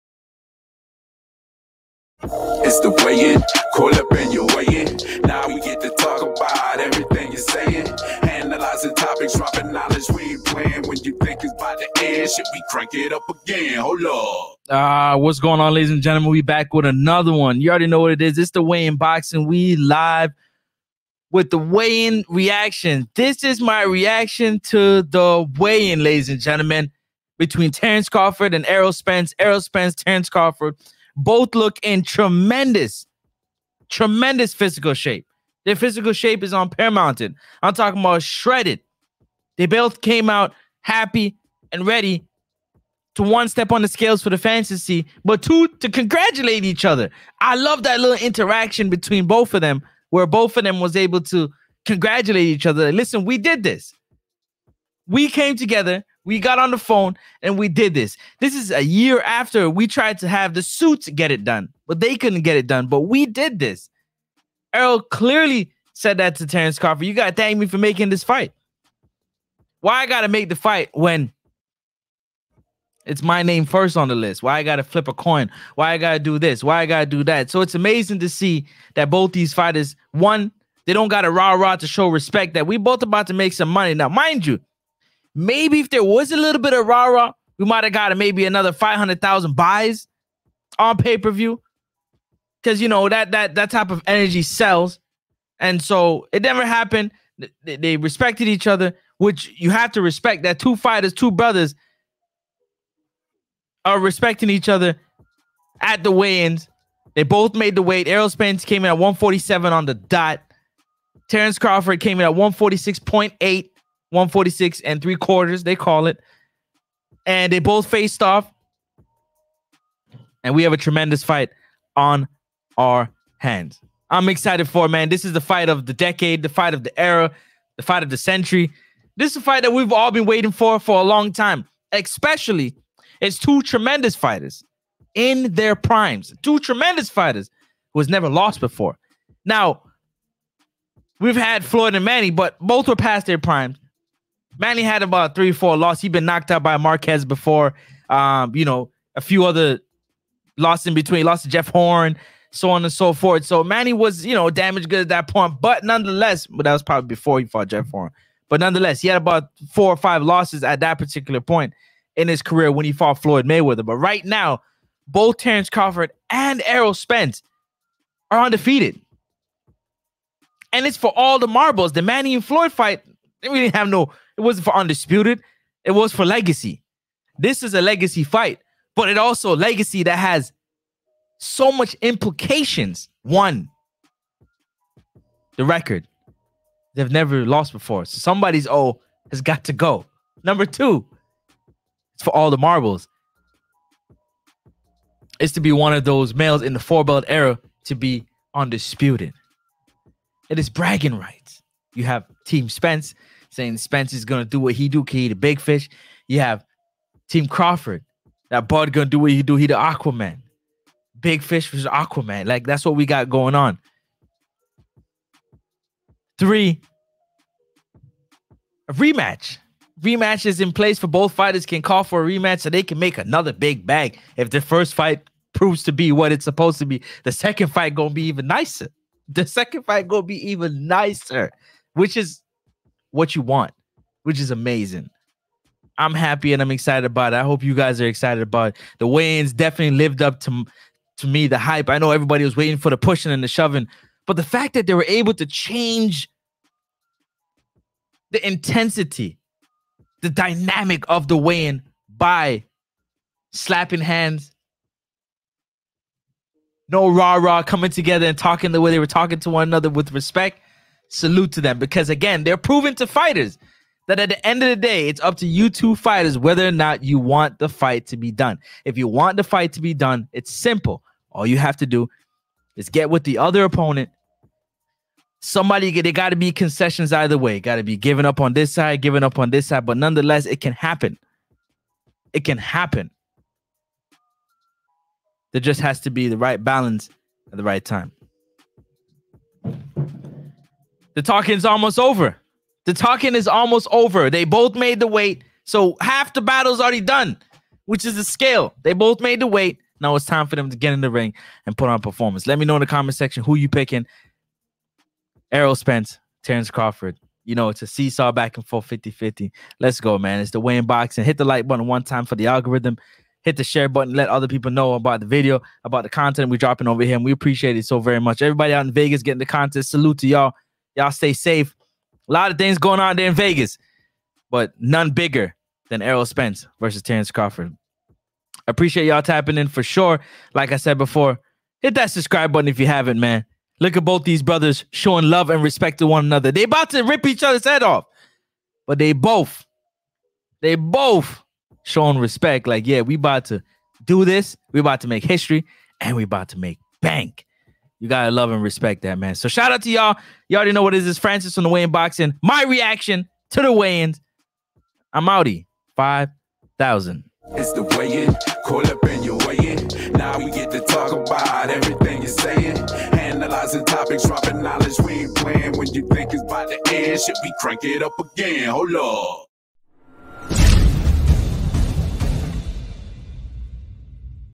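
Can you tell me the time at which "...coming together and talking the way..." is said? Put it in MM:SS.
04:17.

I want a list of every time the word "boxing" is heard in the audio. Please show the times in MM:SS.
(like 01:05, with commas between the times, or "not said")
00:18, 05:10, 05:51.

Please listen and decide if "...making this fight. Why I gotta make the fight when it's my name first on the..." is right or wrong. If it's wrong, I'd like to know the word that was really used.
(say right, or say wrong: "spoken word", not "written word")
right.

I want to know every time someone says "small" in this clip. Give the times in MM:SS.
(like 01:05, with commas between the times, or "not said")
not said.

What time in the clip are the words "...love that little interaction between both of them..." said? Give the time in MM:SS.
00:47.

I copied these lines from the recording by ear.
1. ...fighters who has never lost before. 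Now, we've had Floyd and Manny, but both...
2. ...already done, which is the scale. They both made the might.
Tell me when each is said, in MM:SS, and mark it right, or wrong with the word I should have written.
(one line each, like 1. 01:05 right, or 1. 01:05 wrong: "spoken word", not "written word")
1. 02:17 right
2. 04:56 wrong: "weight", not "might".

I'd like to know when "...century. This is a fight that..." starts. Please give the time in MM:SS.
02:08.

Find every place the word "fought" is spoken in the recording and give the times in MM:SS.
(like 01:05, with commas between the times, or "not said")
02:37, 02:42.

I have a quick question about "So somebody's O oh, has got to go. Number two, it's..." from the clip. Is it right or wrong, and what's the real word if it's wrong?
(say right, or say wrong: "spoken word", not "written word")
right.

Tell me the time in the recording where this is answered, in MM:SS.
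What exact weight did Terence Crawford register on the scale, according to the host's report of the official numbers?
01:52.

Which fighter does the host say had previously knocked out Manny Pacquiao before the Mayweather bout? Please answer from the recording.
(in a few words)
Marquez.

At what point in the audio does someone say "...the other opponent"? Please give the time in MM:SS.
04:33.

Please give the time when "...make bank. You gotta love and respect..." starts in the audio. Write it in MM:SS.
05:46.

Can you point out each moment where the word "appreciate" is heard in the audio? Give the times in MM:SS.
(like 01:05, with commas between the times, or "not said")
05:17, 05:28.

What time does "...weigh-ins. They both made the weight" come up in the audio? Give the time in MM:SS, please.
01:46.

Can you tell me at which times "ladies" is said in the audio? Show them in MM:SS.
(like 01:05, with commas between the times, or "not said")
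00:15, 00:26.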